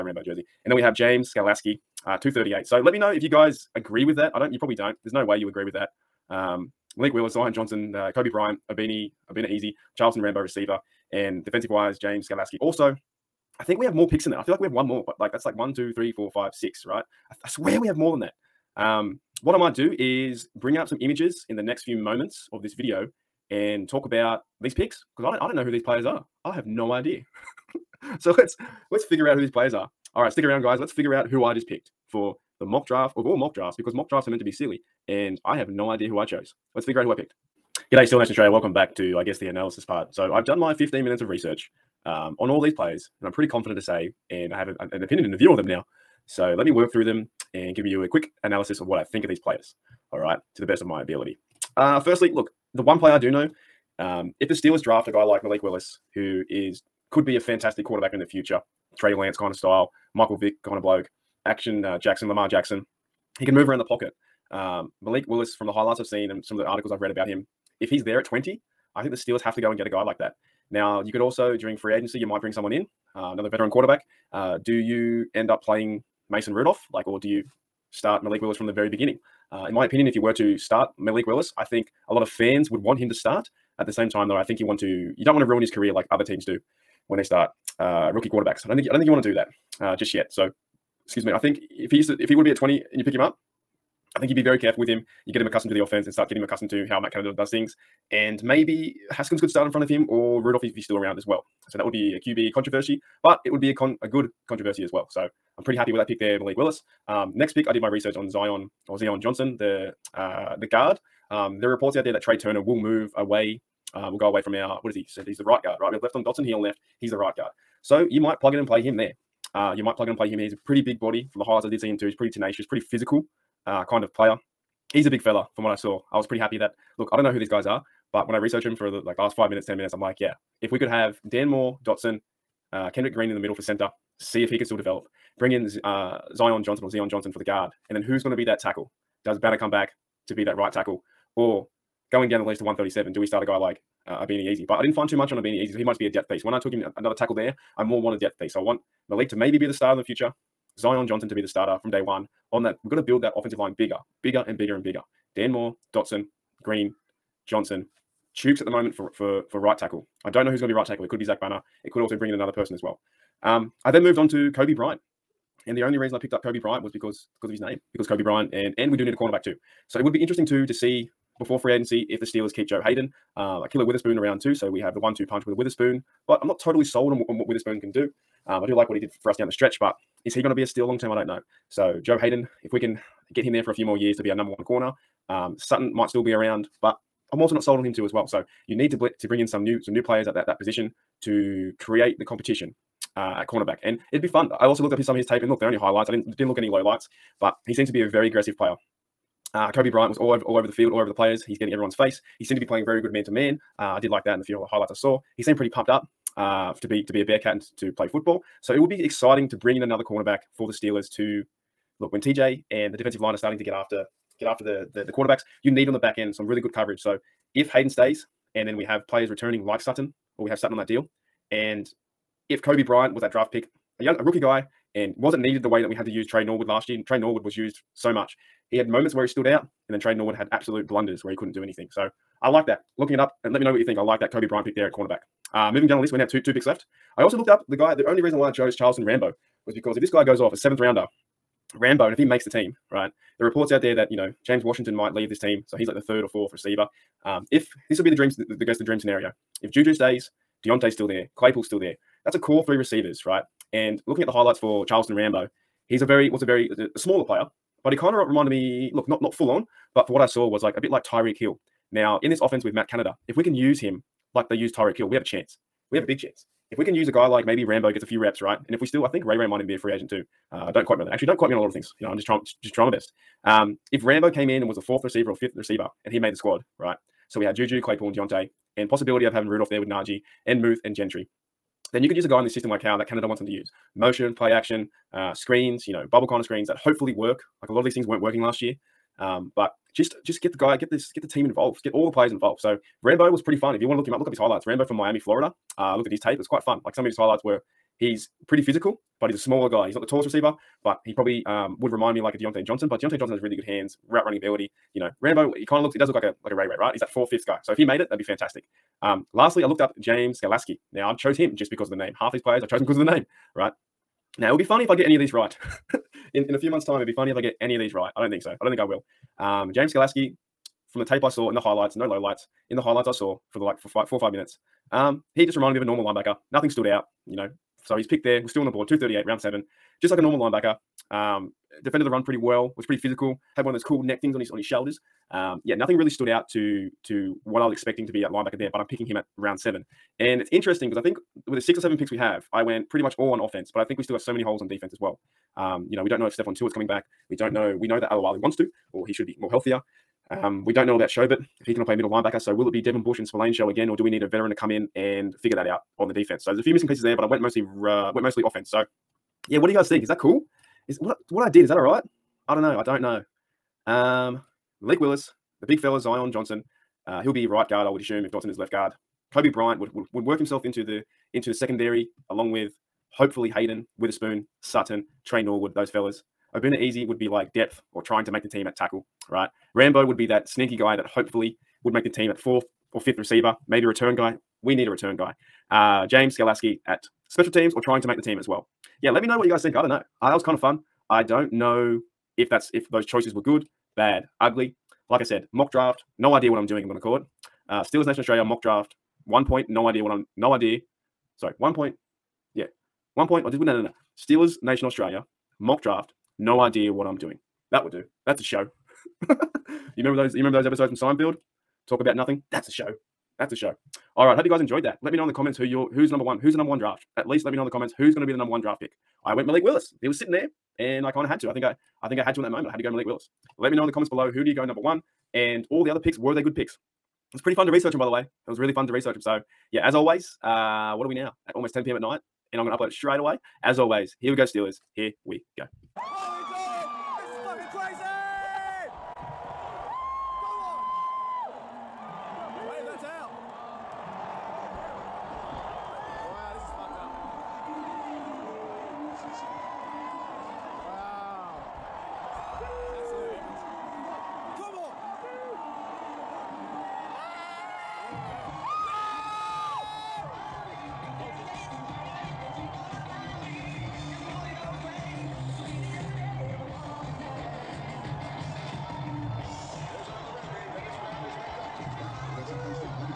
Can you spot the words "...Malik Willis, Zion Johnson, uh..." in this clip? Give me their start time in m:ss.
0:06.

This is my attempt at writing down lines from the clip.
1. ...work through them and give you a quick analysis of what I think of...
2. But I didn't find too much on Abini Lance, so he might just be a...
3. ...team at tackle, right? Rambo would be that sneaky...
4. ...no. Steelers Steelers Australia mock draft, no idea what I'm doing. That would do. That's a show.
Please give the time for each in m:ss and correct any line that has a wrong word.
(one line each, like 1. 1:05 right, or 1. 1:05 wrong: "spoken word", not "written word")
1. 0:46 right
2. 2:24 wrong: "Eze", not "Lance"
3. 6:18 right
4. 6:43 wrong: "Nation", not "Steelers".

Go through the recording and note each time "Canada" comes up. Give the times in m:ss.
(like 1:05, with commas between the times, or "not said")
1:37, 4:22, 4:43.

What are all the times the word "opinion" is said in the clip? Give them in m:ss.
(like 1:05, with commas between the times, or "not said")
0:45, 1:19.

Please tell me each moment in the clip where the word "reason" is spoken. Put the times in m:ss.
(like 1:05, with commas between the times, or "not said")
2:45, 3:58.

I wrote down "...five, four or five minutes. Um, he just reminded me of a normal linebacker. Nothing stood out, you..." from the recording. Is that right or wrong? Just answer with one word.
right.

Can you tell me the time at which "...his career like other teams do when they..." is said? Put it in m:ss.
1:25.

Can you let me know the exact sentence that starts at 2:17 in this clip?
And then who's going to be that tackle?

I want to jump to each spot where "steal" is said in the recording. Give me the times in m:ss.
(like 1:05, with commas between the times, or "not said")
3:00.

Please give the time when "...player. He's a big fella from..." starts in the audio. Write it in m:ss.
2:04.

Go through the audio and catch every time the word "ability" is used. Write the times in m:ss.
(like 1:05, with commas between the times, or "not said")
0:51, 5:04.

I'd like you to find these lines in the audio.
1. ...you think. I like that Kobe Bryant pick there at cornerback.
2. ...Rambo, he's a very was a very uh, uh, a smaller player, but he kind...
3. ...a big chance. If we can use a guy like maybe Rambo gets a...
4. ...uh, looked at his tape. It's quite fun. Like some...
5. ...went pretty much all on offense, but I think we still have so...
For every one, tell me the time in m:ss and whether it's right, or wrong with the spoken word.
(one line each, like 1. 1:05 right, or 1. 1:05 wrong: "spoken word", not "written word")
1. 3:53 right
2. 4:15 right
3. 4:26 right
4. 4:55 right
5. 5:42 right.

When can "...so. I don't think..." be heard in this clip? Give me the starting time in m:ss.
5:18.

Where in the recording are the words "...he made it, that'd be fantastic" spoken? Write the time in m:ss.
5:07.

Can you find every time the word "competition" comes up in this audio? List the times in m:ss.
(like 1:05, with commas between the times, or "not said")
3:12.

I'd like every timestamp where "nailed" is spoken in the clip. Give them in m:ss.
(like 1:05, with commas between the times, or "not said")
not said.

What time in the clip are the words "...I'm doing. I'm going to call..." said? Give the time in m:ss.
6:36.